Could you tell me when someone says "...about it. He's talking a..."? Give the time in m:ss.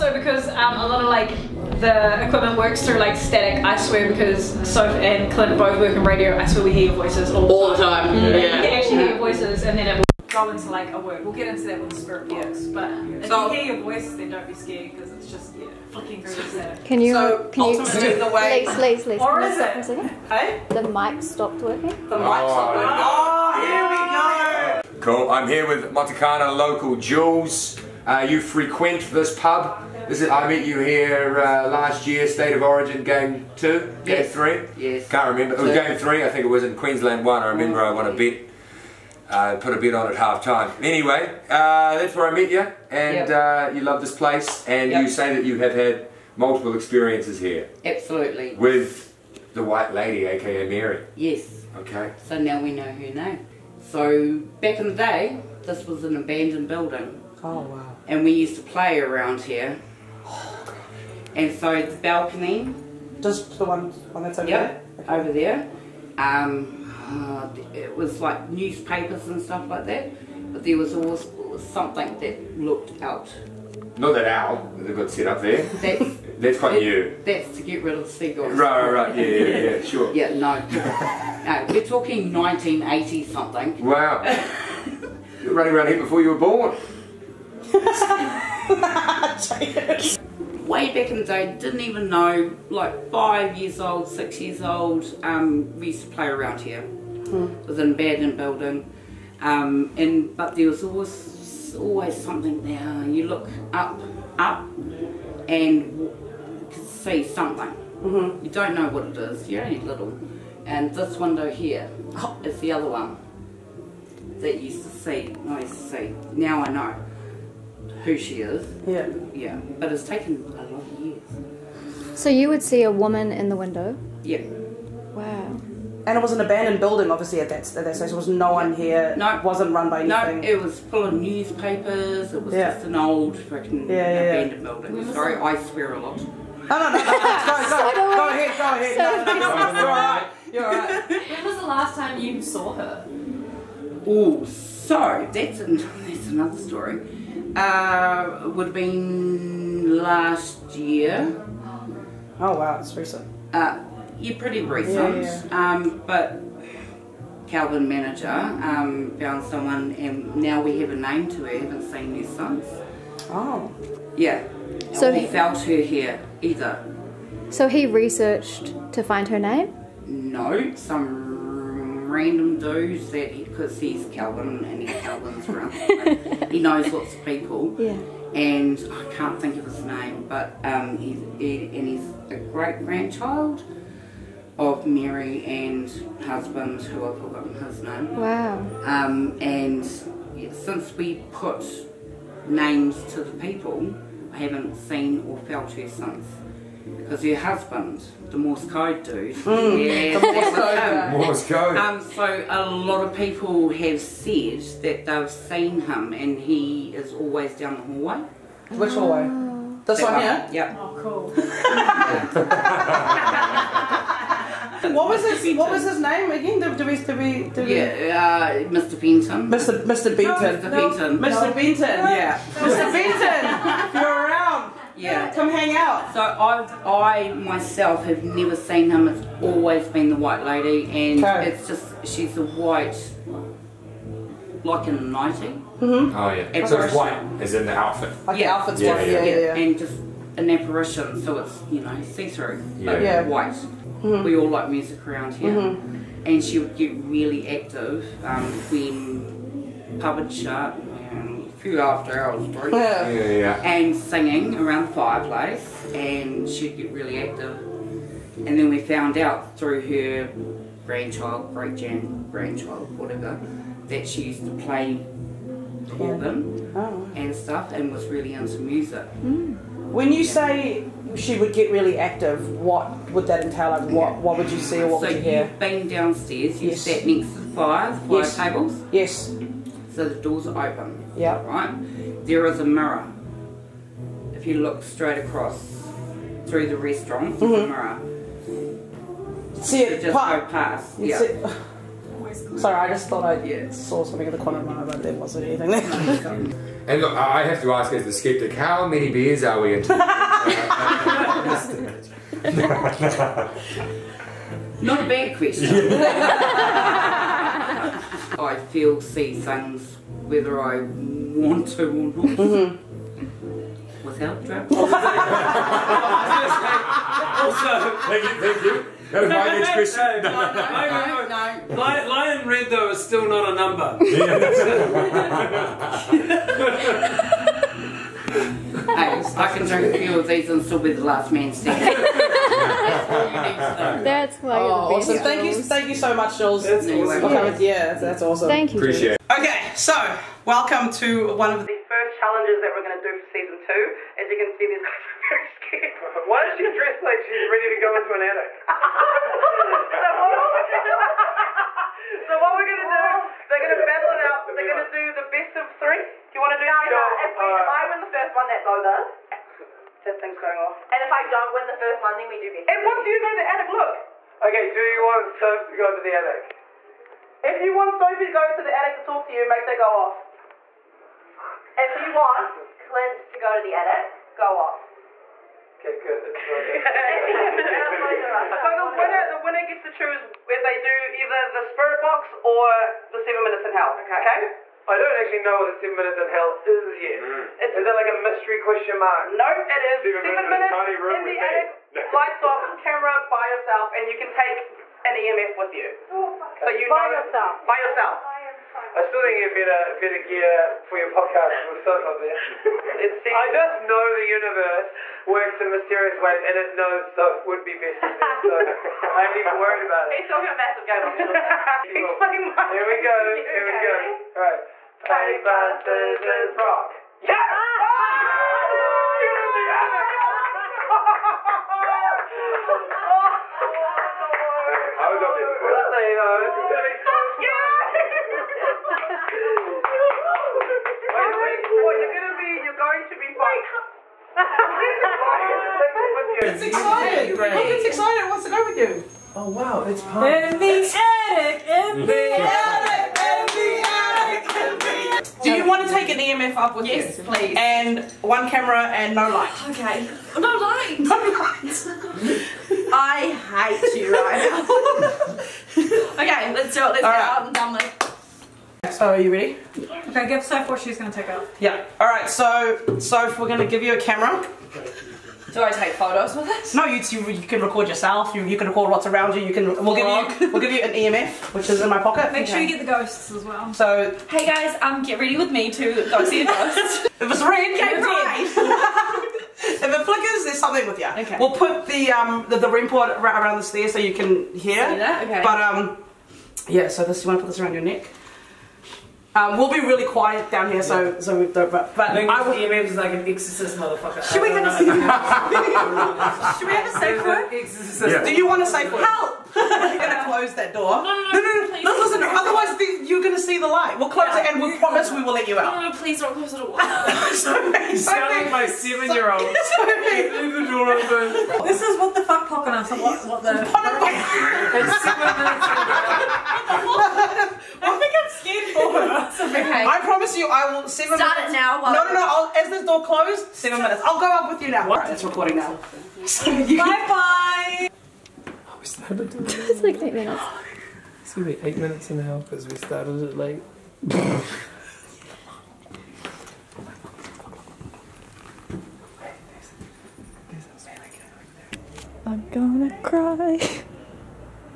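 6:49.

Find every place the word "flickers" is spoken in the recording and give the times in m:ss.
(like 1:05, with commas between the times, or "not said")
8:00.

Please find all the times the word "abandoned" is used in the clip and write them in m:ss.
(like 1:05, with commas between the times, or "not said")
0:56, 1:37, 2:06, 2:14.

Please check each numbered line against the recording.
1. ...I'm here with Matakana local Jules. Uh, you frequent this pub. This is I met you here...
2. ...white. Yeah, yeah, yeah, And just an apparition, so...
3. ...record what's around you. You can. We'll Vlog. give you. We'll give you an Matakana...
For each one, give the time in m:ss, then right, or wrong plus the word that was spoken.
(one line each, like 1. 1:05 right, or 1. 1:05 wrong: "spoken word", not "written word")
1. 0:25 right
2. 3:58 right
3. 7:48 wrong: "EMF", not "Matakana".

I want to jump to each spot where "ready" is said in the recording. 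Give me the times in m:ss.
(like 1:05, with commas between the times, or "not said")
5:47, 7:39, 7:55.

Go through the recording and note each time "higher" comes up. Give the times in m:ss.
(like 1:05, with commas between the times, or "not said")
not said.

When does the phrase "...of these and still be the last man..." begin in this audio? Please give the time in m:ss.
5:30.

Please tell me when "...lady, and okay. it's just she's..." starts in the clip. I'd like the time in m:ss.
3:50.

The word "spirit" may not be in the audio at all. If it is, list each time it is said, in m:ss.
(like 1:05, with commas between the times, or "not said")
0:12, 6:21.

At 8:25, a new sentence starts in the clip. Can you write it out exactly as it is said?
No, no, please don't close the door.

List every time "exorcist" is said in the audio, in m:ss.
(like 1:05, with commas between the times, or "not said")
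8:13, 8:17.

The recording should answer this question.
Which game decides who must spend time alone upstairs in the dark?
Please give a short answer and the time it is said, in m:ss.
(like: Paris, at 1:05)
Paper, scissors, rock, at 6:55.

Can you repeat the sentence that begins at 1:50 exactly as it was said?
And this window here oh, is the other one that you used to see, I used to see.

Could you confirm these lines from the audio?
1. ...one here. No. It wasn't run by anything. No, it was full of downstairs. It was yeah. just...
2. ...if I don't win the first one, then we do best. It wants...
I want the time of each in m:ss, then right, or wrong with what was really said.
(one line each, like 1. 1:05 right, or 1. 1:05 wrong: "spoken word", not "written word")
1. 2:08 wrong: "newspapers", not "downstairs"
2. 6:01 right.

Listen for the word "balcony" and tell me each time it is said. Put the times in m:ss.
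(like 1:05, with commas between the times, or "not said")
1:01.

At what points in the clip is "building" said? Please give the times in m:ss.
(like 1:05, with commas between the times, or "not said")
0:56, 1:38, 2:06, 2:14.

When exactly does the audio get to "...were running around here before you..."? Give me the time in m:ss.
1:25.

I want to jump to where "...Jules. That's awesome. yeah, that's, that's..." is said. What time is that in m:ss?
5:36.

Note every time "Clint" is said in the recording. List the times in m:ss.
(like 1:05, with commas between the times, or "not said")
0:05, 6:12.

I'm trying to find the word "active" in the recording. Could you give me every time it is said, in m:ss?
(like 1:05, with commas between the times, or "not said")
4:07, 4:17, 4:31.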